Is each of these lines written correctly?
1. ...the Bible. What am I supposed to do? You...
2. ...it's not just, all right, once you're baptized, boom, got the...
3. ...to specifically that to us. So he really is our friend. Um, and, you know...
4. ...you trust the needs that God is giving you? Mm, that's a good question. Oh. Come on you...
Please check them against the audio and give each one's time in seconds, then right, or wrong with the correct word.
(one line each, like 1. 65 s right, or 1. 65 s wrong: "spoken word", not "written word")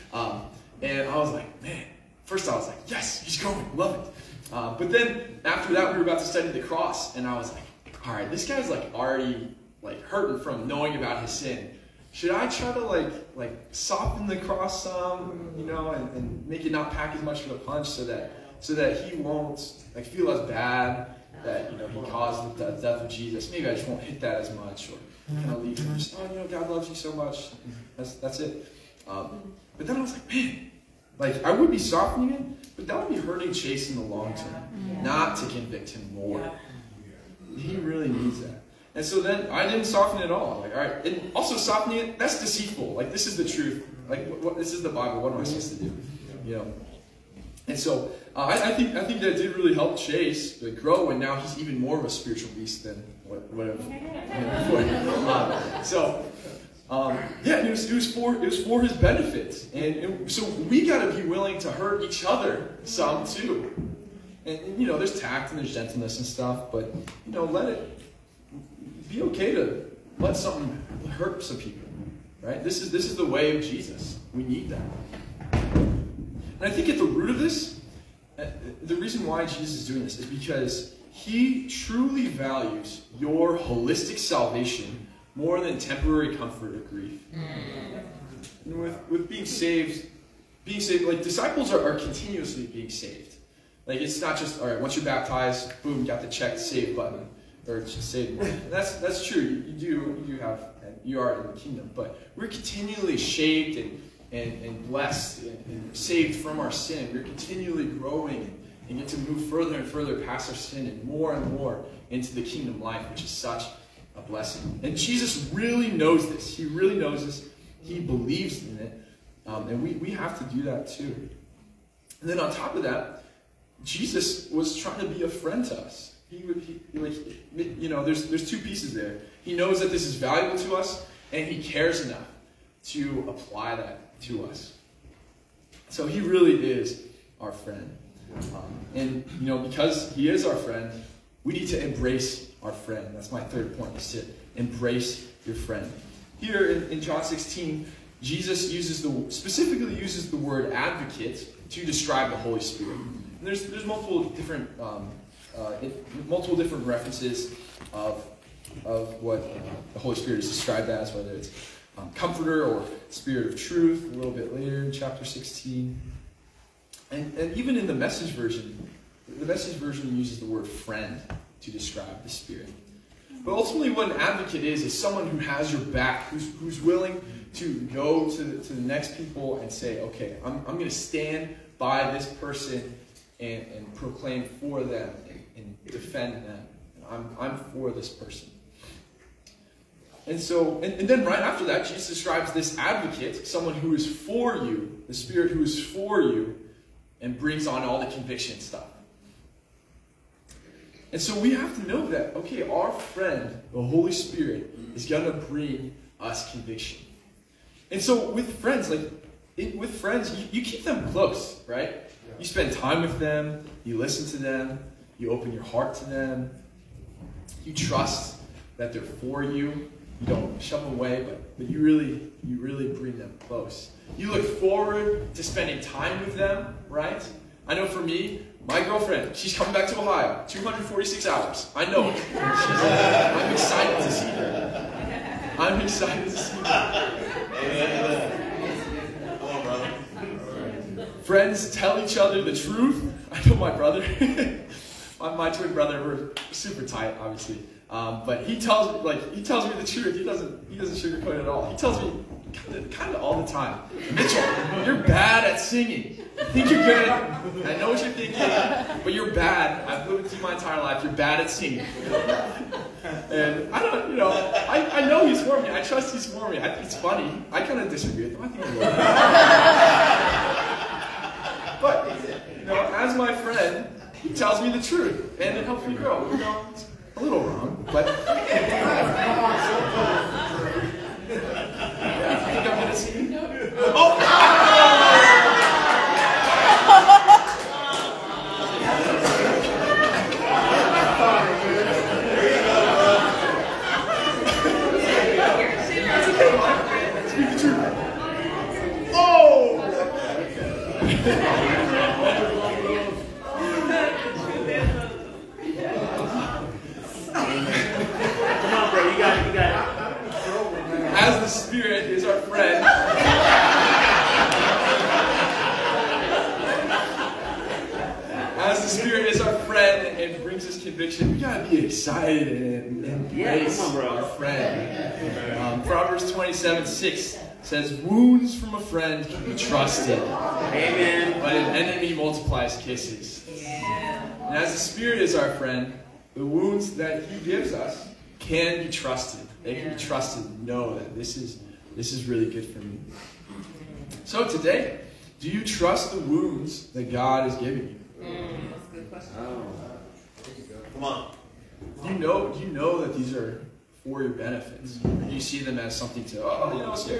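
1. 44 s right
2. 94 s right
3. 132 s wrong: "apply", not "specifically"
4. 345 s wrong: "wounds", not "needs".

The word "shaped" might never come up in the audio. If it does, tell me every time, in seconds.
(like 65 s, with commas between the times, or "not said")
103 s.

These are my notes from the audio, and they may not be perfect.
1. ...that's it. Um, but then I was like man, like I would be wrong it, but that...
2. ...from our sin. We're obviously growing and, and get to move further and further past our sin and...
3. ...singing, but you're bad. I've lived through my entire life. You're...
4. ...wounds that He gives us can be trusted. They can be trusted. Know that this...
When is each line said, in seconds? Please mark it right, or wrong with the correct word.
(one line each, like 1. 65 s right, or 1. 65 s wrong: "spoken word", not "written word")
1. 28 s wrong: "softening", not "wrong"
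2. 106 s wrong: "continually", not "obviously"
3. 258 s wrong: "thinking", not "singing"
4. 336 s right.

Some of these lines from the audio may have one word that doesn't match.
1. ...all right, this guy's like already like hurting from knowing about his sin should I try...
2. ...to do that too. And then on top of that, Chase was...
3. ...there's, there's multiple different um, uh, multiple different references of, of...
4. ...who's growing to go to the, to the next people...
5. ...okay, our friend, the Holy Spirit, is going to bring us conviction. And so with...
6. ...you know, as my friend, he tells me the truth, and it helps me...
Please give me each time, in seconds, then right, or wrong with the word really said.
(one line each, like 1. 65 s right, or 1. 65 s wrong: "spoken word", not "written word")
1. 8 s right
2. 120 s wrong: "Jesus", not "Chase"
3. 153 s right
4. 176 s wrong: "willing", not "growing"
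5. 202 s right
6. 272 s right.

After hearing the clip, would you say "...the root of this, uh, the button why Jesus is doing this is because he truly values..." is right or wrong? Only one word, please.
wrong.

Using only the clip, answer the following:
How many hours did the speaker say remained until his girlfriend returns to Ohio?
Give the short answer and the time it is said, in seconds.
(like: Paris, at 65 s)
246, at 230 s.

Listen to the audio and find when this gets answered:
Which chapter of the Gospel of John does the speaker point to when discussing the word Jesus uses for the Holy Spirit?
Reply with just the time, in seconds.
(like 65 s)
147 s.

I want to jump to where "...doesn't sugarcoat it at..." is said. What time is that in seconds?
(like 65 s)
250 s.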